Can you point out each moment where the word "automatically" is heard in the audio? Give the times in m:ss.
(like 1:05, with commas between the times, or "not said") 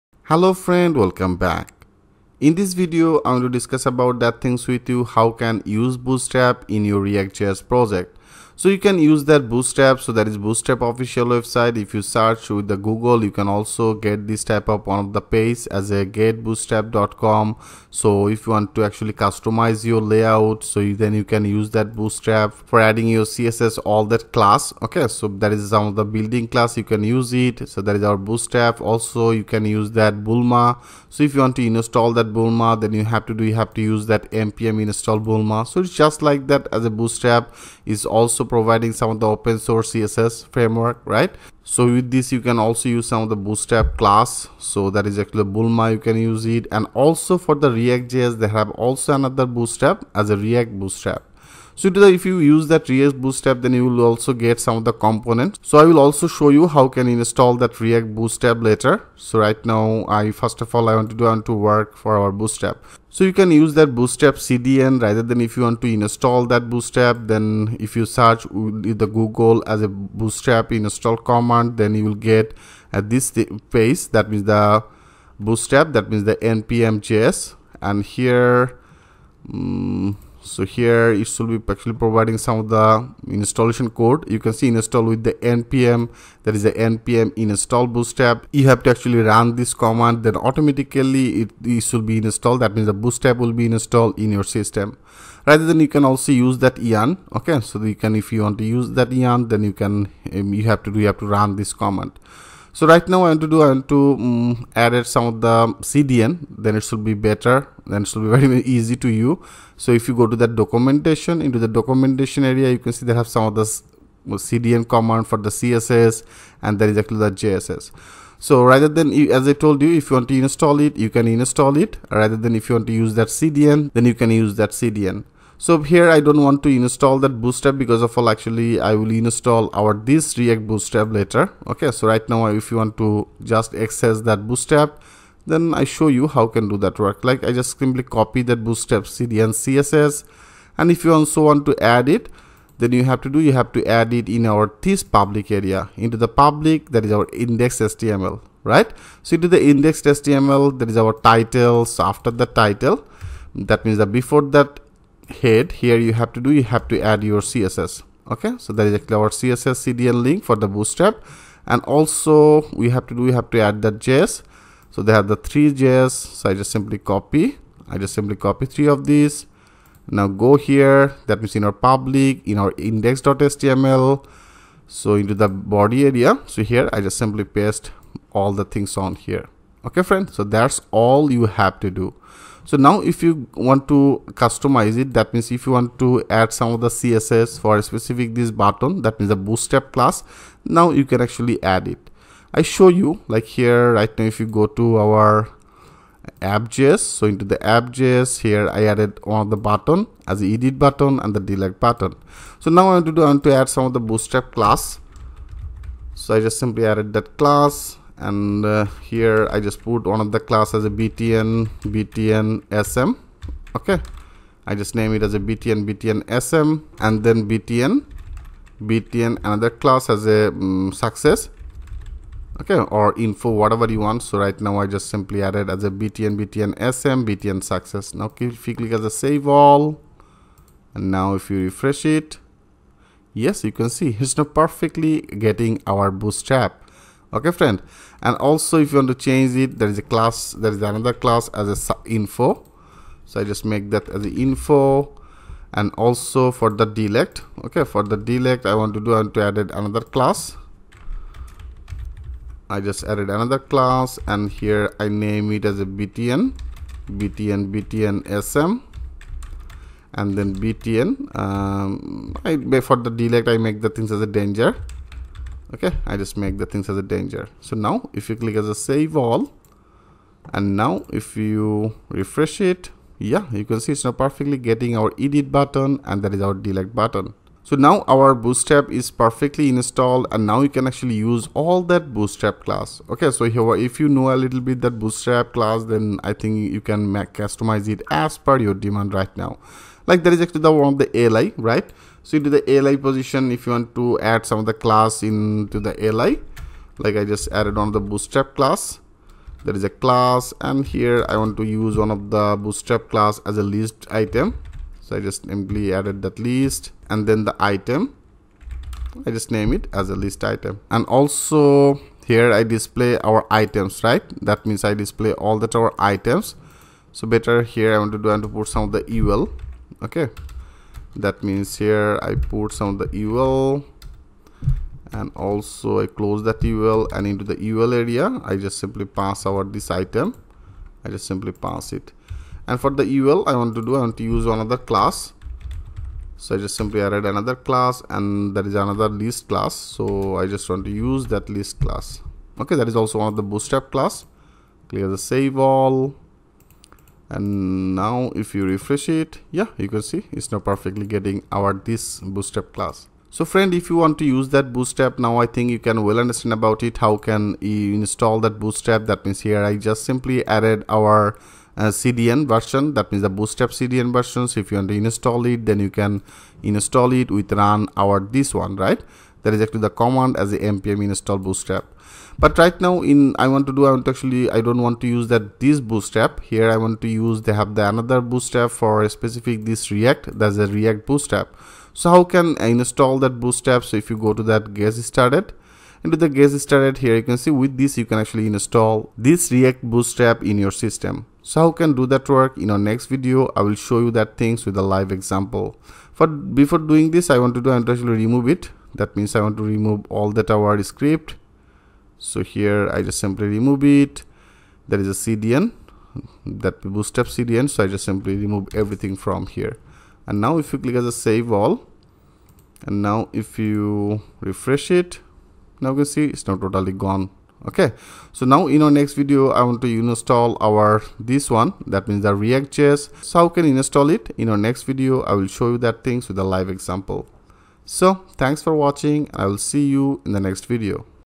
1:30.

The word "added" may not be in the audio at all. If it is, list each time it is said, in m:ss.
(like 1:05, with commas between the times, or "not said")
3:18, 3:26, 3:45, 4:13, 4:57, 5:05, 5:37, 6:00.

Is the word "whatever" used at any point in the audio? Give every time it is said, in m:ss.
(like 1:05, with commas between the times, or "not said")
3:43.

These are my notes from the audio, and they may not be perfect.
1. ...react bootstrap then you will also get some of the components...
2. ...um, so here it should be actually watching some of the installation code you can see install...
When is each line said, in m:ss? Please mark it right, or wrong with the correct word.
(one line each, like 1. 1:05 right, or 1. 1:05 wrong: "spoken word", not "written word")
1. 0:52 right
2. 1:19 wrong: "providing", not "watching".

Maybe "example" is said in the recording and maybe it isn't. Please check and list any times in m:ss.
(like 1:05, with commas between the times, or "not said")
6:35, 7:06.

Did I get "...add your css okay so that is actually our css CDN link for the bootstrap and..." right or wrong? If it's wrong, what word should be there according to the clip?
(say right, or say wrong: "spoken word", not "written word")
right.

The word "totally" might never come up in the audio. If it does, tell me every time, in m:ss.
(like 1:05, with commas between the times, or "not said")
6:56.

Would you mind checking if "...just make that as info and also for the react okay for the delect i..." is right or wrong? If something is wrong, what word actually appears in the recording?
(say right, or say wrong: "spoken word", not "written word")
wrong: "delect", not "react".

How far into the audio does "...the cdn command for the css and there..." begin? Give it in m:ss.
1:53.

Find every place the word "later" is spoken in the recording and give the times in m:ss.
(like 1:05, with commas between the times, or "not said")
0:58, 2:11.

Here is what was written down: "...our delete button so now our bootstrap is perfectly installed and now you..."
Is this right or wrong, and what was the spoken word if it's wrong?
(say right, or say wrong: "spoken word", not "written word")
right.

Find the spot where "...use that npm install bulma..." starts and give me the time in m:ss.
0:33.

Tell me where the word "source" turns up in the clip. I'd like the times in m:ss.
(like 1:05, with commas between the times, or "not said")
0:39.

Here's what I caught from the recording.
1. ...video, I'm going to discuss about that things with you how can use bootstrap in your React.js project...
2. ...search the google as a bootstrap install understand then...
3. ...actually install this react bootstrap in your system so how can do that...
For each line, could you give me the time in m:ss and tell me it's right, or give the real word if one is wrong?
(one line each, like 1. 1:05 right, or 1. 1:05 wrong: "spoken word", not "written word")
1. 0:02 right
2. 1:08 wrong: "command", not "understand"
3. 6:28 right.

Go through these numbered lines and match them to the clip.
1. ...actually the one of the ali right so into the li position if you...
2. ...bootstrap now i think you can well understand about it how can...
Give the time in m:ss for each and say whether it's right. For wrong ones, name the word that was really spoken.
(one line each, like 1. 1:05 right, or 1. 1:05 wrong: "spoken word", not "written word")
1. 4:50 right
2. 5:54 right.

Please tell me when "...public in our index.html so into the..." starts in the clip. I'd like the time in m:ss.
2:51.